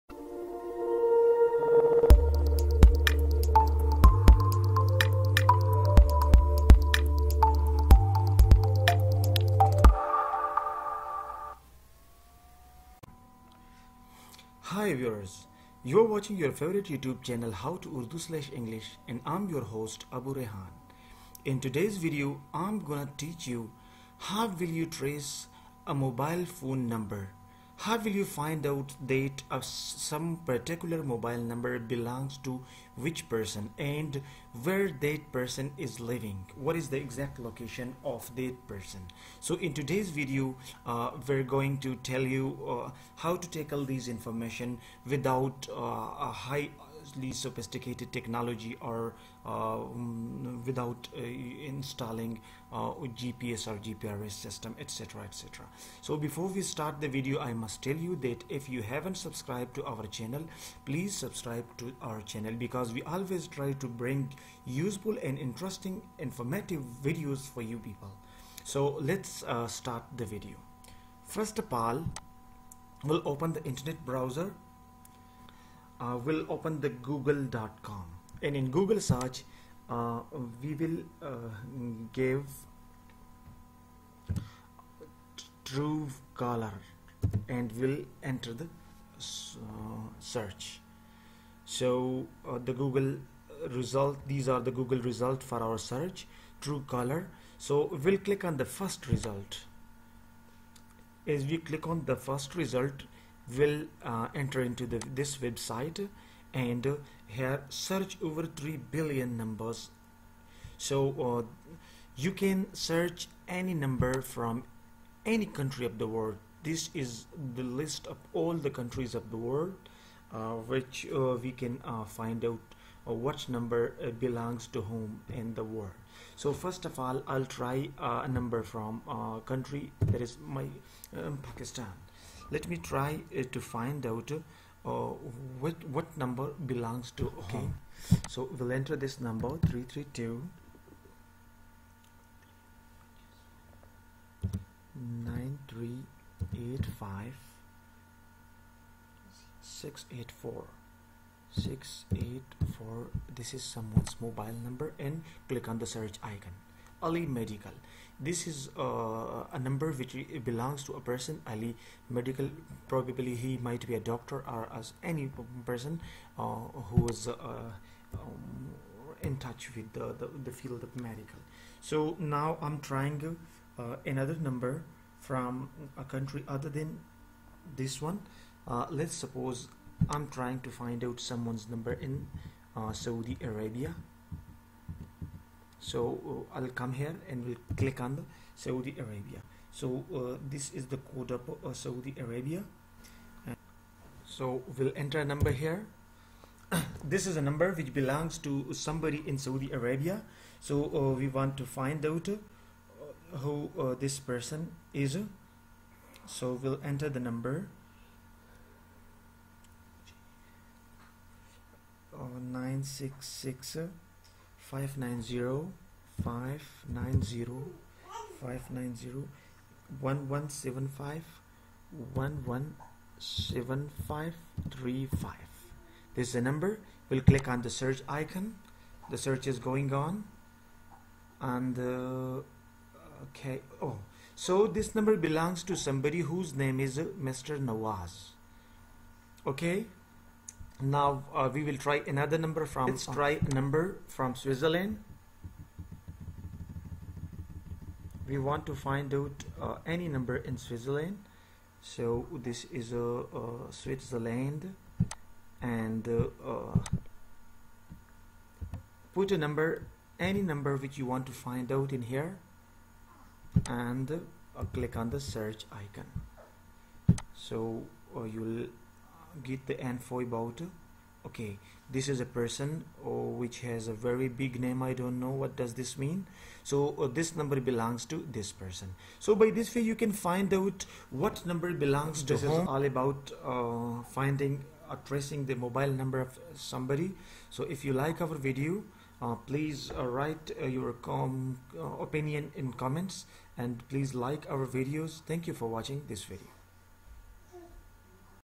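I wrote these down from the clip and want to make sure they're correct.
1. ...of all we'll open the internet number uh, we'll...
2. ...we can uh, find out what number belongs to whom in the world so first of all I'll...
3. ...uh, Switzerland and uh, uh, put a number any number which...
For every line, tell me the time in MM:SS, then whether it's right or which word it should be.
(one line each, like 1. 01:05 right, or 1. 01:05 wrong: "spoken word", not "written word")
1. 01:11 wrong: "browser", not "number"
2. 02:01 right
3. 04:13 right.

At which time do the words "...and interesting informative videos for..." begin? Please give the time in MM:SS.
01:05.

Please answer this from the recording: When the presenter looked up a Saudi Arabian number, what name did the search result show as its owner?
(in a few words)
Mr. Nawaz.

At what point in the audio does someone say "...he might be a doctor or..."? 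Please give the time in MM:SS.
02:43.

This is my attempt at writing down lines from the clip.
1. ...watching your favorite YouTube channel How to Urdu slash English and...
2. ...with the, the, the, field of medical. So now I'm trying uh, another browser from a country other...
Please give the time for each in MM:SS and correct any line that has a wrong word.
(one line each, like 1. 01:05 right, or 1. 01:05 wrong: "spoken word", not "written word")
1. 00:16 right
2. 02:49 wrong: "number", not "browser".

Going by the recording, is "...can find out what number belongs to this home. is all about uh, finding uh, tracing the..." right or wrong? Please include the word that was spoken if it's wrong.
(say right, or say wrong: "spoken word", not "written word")
right.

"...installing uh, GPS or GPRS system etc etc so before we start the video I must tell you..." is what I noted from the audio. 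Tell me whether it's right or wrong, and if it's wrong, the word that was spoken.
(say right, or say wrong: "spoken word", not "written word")
right.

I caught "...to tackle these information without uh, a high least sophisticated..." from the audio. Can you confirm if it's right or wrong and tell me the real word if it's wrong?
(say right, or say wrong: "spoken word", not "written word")
right.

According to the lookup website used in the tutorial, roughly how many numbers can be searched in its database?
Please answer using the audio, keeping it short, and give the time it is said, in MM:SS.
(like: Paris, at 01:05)
3 billion, at 01:48.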